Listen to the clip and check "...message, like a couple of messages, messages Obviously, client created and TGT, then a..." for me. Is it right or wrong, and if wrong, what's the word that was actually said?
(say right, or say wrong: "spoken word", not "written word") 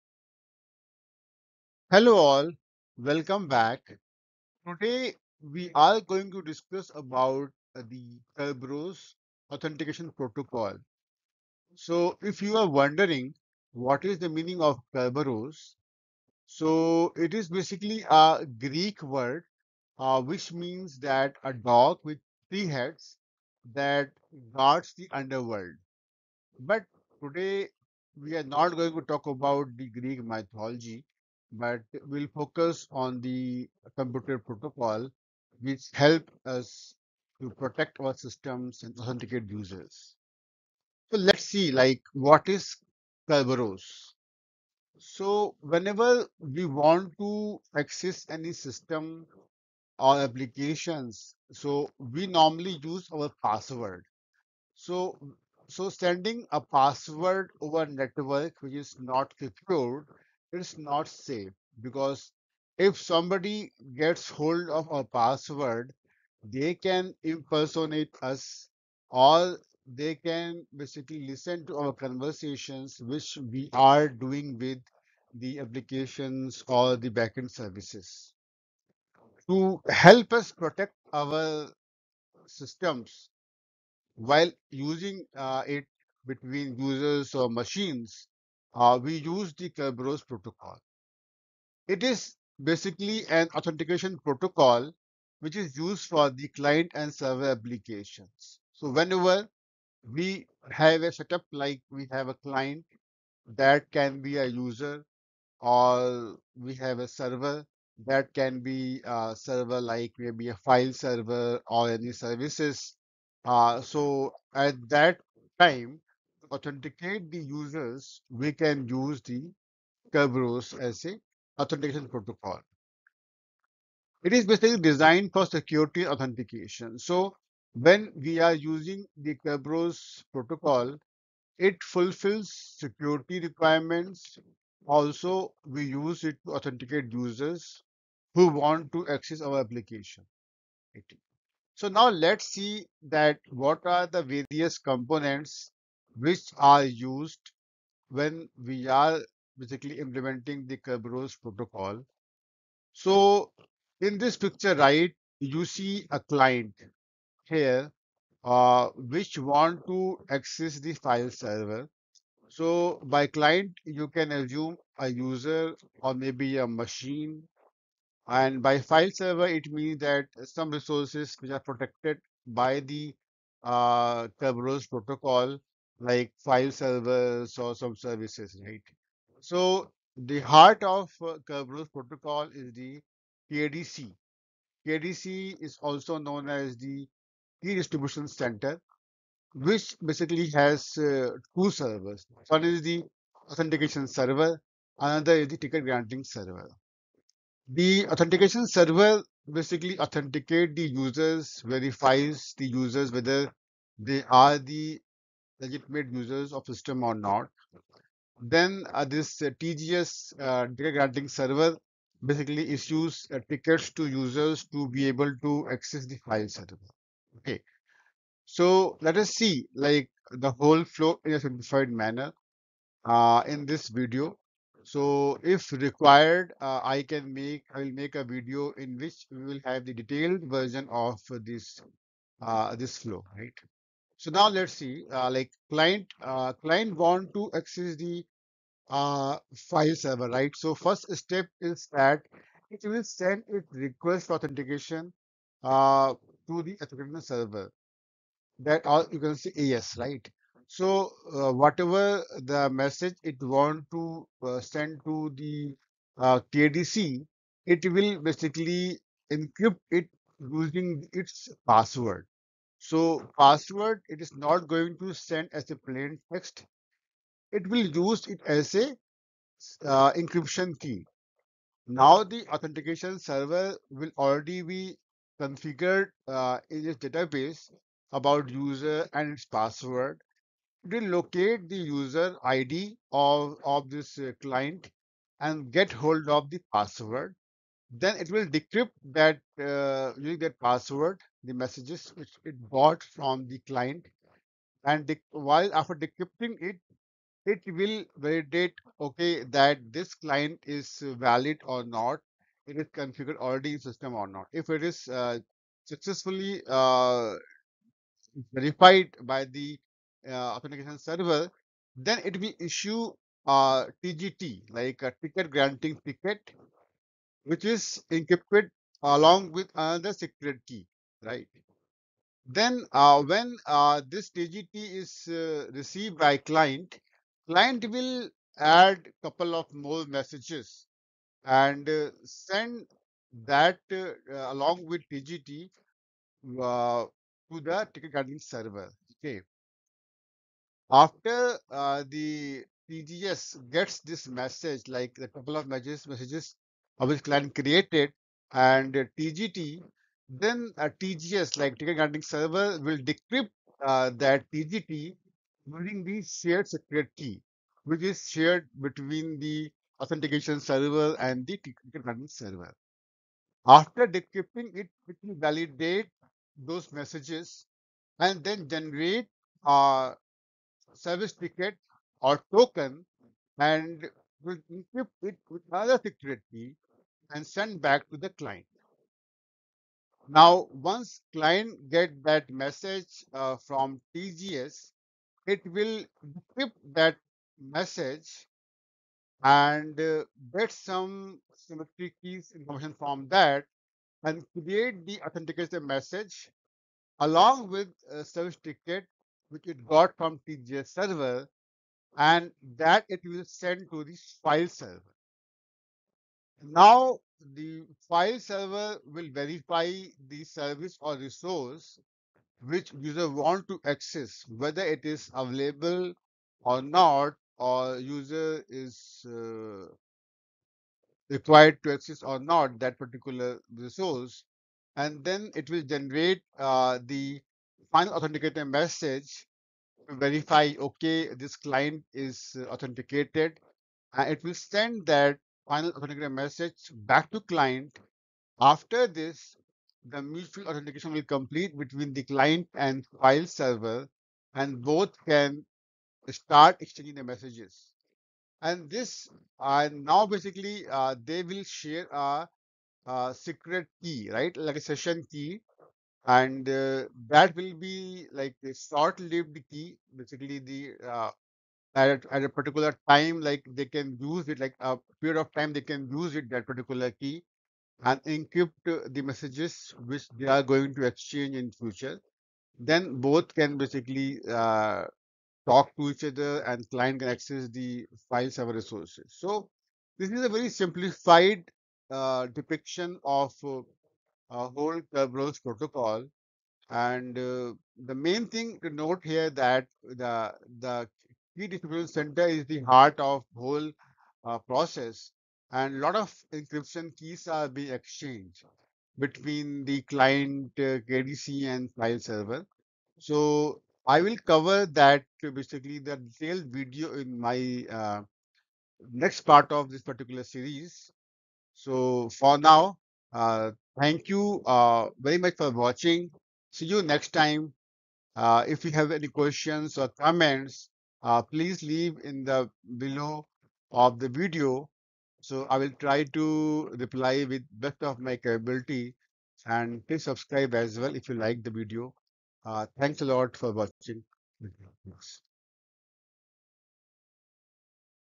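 right.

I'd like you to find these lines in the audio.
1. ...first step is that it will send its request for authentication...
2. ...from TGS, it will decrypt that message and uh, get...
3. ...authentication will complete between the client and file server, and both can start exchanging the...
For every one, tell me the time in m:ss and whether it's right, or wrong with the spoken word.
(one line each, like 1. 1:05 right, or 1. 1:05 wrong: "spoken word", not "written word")
1. 4:00 right
2. 6:23 right
3. 7:20 right.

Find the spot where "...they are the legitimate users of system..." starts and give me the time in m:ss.
3:23.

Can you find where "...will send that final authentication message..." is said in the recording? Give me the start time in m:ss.
7:14.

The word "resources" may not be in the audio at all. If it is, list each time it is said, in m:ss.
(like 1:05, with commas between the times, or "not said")
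2:50, 6:51, 7:03, 7:58.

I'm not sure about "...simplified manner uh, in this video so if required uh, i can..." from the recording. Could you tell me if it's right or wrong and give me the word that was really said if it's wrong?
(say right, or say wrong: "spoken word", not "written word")
right.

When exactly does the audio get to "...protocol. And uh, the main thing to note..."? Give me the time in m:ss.
8:05.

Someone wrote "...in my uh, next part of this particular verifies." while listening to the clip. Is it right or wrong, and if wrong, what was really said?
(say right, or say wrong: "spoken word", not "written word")
wrong: "series", not "verifies".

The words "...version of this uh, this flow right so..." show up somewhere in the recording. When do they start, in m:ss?
3:50.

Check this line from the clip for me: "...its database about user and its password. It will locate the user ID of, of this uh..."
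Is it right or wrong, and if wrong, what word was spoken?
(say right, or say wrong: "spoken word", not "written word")
right.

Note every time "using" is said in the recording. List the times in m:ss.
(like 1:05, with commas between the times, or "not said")
1:24, 2:08, 4:20, 4:50, 5:55.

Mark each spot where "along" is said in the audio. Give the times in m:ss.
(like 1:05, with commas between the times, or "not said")
5:19, 5:34, 6:37.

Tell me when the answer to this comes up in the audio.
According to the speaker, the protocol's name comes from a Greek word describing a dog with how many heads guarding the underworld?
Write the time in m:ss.
0:22.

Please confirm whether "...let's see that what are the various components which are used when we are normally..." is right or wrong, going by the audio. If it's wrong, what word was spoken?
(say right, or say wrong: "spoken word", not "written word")
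wrong: "basically", not "normally".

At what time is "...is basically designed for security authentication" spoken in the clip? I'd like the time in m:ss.
2:04.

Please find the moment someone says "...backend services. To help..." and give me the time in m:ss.
1:17.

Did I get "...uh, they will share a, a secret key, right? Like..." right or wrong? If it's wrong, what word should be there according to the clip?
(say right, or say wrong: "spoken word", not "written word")
right.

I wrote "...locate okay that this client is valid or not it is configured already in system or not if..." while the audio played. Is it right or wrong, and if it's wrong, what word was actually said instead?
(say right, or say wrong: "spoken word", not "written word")
wrong: "validate", not "locate".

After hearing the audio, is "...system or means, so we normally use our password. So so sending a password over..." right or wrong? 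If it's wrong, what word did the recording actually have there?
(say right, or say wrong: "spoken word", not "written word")
wrong: "applications", not "means".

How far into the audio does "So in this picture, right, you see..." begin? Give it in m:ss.
2:32.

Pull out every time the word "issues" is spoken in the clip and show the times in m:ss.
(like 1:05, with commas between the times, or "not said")
3:32, 5:12.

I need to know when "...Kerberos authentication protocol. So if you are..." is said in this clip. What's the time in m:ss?
0:08.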